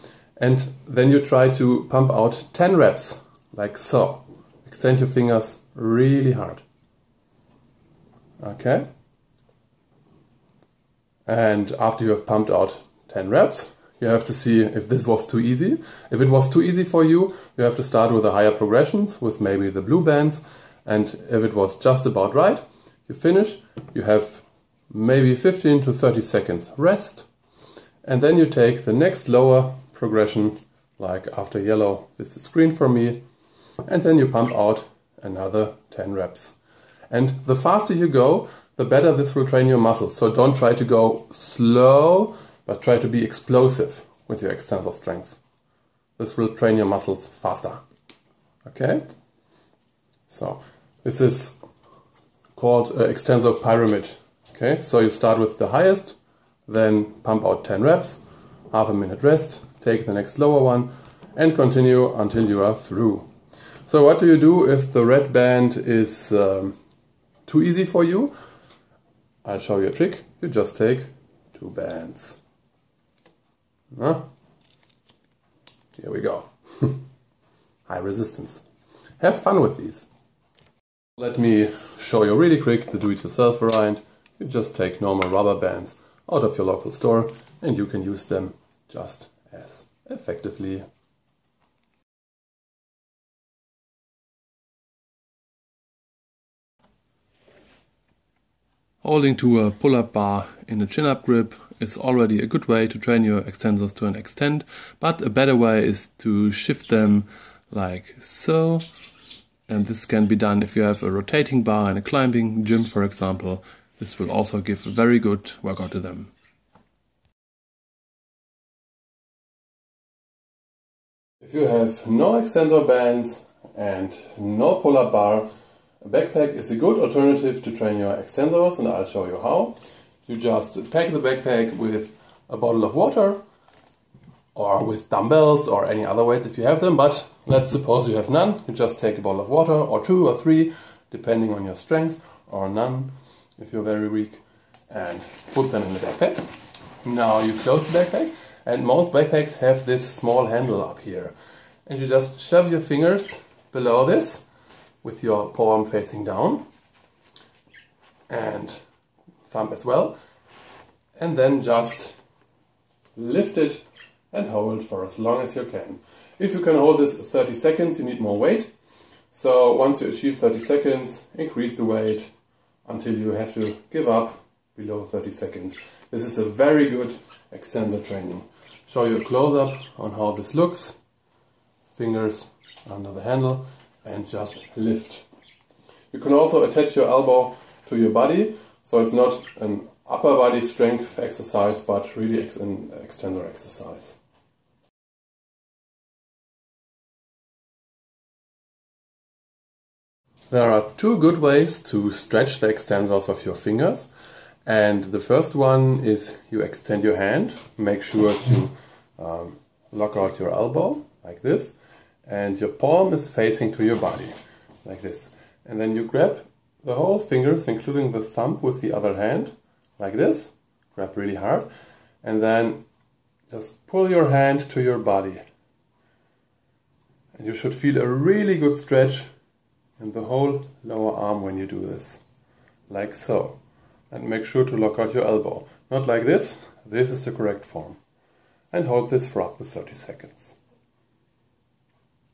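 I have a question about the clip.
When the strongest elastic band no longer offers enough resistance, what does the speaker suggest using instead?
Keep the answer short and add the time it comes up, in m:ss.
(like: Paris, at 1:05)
two bands, at 1:11.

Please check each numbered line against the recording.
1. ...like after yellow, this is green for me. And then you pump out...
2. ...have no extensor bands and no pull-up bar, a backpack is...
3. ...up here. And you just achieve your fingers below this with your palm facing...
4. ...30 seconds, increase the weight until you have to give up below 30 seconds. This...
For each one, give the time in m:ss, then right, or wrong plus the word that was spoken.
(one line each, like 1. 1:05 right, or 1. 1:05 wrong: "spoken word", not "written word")
1. 0:30 right
2. 2:01 right
3. 2:30 wrong: "shove", not "achieve"
4. 2:50 right.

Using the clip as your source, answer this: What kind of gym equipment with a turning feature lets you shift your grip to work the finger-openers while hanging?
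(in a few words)
rotating bar.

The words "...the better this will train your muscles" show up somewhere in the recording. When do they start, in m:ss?
0:38.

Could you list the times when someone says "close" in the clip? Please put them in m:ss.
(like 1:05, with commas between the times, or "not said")
2:27, 2:59.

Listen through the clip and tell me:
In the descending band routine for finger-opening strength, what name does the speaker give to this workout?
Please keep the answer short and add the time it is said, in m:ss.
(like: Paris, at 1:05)
extensor pyramid, at 0:53.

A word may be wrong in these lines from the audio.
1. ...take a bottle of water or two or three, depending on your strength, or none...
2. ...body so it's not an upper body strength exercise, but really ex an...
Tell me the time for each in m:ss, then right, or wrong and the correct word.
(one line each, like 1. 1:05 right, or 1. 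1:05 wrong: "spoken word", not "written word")
1. 2:18 right
2. 3:08 right.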